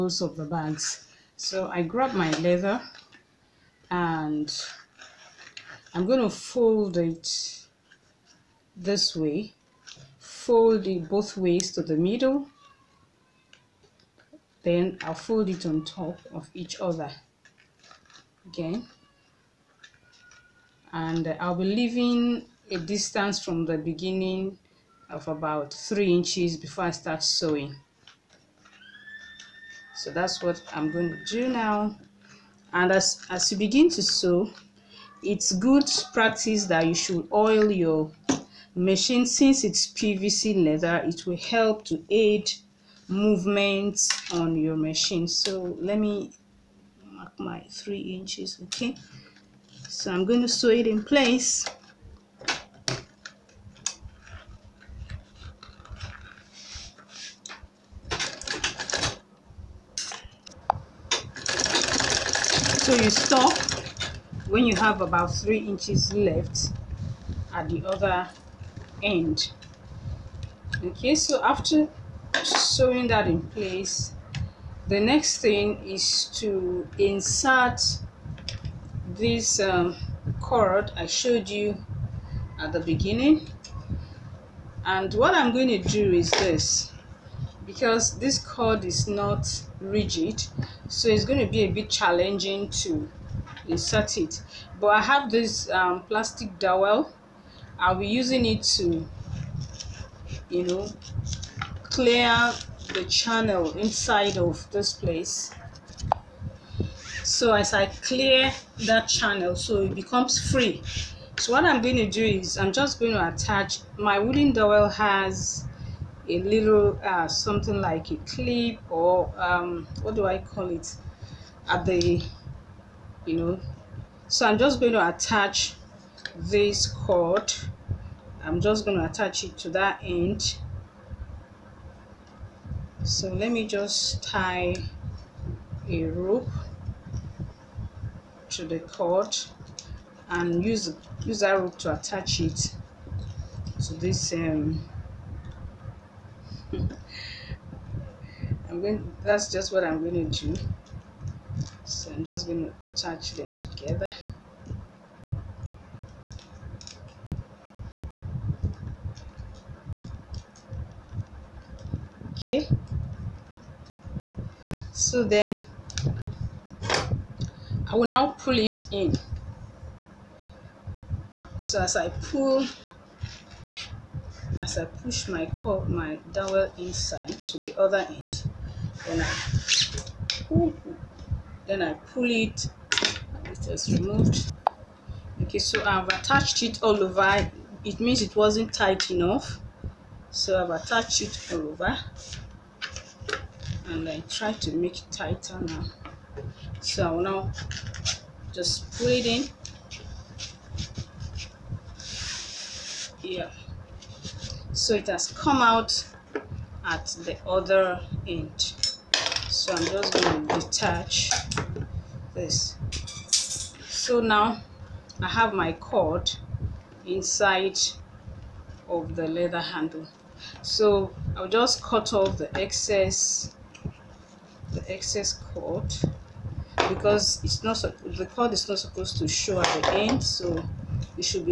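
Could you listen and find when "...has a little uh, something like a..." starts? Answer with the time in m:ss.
1:54.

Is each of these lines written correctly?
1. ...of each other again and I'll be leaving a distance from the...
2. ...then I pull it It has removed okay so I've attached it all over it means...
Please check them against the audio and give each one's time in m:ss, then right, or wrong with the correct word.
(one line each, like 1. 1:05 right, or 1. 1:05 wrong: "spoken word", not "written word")
1. 0:16 right
2. 3:01 right.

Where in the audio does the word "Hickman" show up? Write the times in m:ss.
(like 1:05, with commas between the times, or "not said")
not said.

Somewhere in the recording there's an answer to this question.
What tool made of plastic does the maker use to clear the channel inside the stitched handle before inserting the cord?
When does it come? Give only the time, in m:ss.
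1:36.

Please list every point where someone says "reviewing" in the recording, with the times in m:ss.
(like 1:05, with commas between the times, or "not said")
not said.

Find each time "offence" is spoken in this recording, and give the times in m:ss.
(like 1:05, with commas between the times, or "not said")
not said.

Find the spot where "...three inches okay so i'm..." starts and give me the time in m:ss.
0:47.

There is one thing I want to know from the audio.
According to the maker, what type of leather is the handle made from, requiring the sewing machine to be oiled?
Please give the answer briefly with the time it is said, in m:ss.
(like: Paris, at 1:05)
PVC leather, at 0:39.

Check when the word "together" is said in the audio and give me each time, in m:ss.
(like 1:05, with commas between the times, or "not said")
2:33.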